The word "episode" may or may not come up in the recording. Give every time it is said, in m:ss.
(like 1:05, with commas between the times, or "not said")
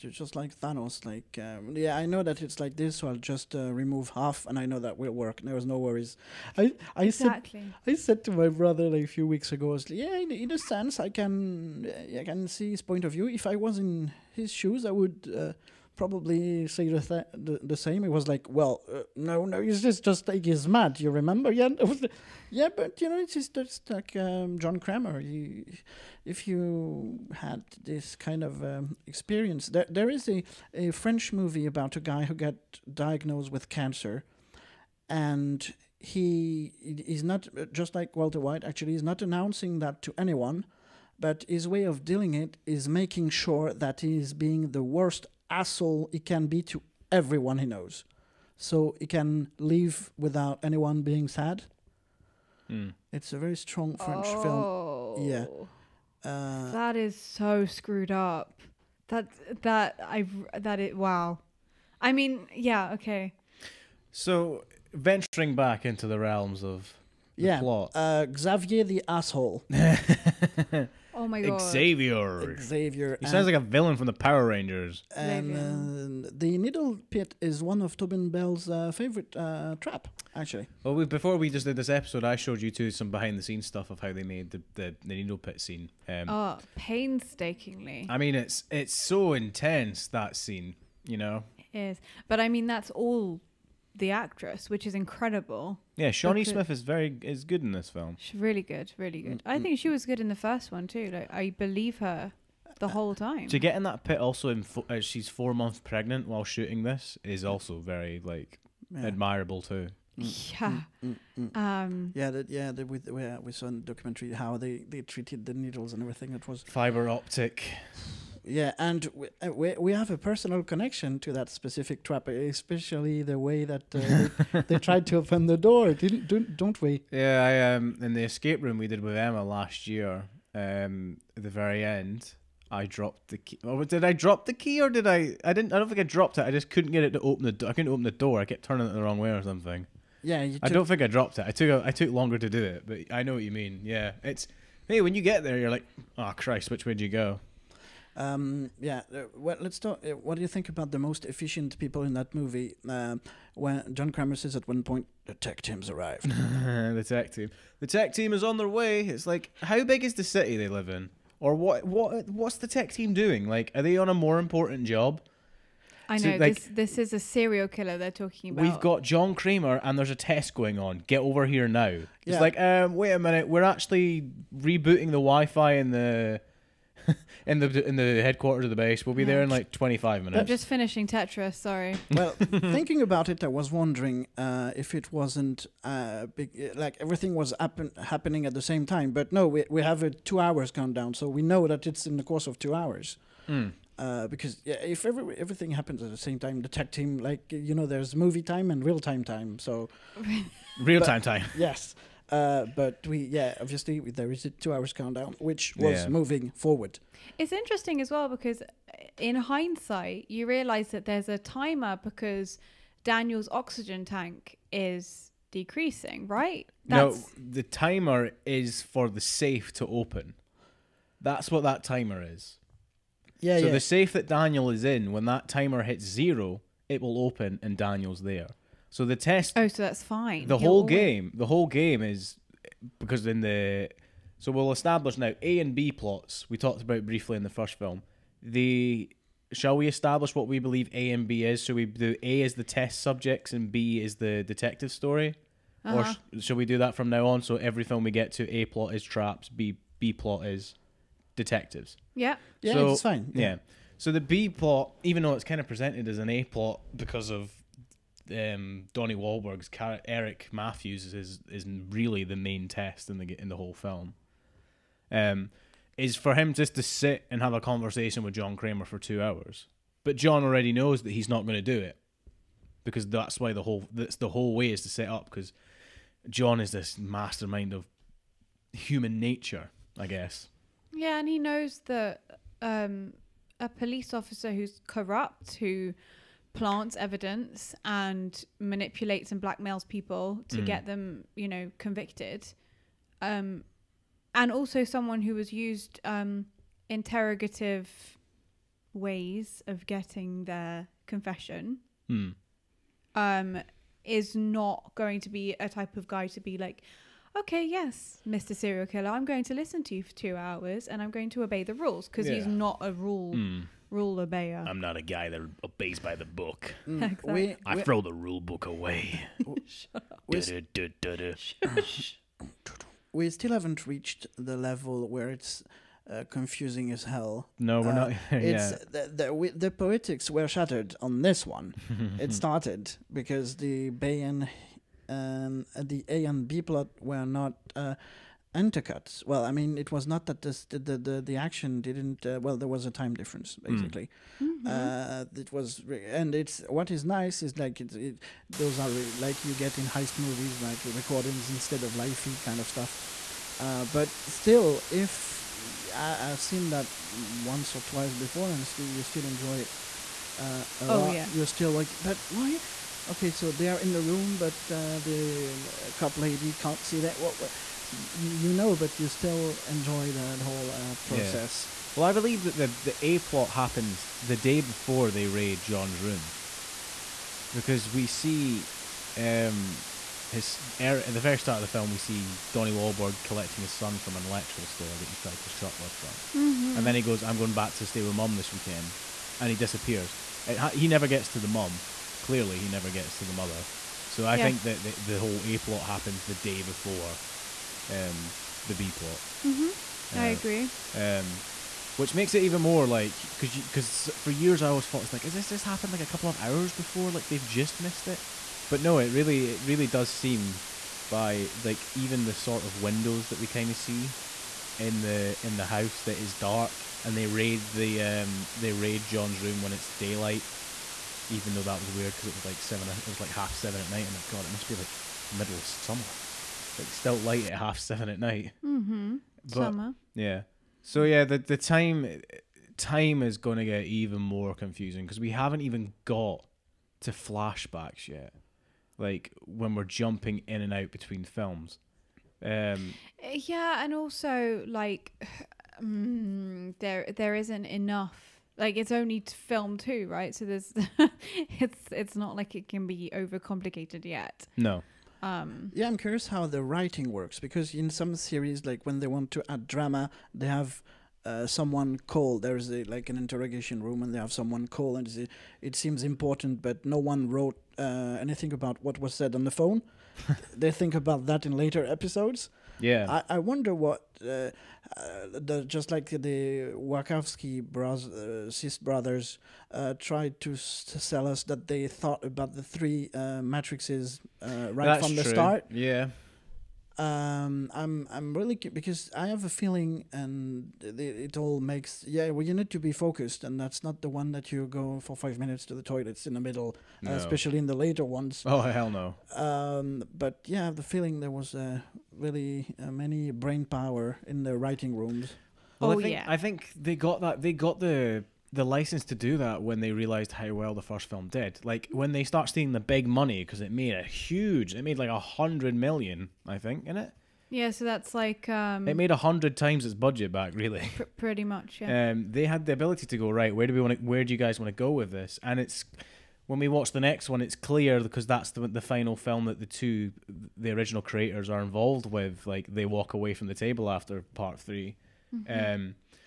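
1:21, 7:51.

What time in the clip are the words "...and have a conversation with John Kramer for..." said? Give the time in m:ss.
4:27.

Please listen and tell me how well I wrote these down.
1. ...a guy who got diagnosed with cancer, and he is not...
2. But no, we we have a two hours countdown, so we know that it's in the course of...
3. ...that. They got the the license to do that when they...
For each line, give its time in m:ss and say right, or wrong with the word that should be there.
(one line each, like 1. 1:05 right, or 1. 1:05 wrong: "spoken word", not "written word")
1. 0:31 right
2. 3:09 right
3. 8:27 right.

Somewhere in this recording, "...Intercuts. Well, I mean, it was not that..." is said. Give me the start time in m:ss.
5:38.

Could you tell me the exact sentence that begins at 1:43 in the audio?
To get in that pit, also, in fo- uh, she's four months pregnant while shooting this is also very like Yeah.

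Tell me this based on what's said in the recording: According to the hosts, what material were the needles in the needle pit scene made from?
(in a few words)
Fiber optic.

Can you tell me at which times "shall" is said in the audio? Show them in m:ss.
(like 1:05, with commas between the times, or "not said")
3:59, 4:06.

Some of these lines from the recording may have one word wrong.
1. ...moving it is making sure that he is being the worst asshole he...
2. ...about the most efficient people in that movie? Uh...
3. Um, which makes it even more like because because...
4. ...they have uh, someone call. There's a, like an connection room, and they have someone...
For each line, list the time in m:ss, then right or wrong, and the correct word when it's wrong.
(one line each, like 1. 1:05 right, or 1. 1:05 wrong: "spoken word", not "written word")
1. 0:42 wrong: "dealing", not "moving"
2. 2:30 right
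3. 6:40 right
4. 7:40 wrong: "interrogation", not "connection".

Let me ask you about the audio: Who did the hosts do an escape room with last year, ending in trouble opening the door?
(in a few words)
Emma.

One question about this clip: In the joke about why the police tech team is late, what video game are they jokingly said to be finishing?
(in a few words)
Tetris.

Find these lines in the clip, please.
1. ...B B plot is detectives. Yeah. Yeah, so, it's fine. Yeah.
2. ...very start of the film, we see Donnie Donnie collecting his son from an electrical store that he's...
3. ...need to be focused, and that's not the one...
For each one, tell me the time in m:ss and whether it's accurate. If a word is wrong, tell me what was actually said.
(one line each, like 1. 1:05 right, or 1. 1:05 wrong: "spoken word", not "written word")
1. 4:09 right
2. 6:21 wrong: "Wahlberg", not "Donnie"
3. 8:12 right.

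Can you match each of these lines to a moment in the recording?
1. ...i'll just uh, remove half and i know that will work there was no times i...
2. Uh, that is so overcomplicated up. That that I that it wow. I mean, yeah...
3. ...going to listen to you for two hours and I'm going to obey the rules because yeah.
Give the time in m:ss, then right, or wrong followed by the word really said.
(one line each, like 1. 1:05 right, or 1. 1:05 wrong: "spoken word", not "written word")
1. 0:03 wrong: "worries", not "times"
2. 0:56 wrong: "screwed", not "overcomplicated"
3. 5:09 right.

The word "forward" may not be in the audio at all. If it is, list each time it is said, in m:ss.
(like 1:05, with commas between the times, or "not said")
3:26.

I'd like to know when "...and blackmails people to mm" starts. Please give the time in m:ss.
4:49.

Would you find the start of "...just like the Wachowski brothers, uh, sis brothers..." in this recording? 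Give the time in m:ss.
7:55.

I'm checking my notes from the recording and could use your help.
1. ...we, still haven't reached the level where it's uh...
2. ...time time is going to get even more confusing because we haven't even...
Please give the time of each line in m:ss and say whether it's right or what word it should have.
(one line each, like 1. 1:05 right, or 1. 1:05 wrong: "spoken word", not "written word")
1. 5:23 right
2. 7:11 right.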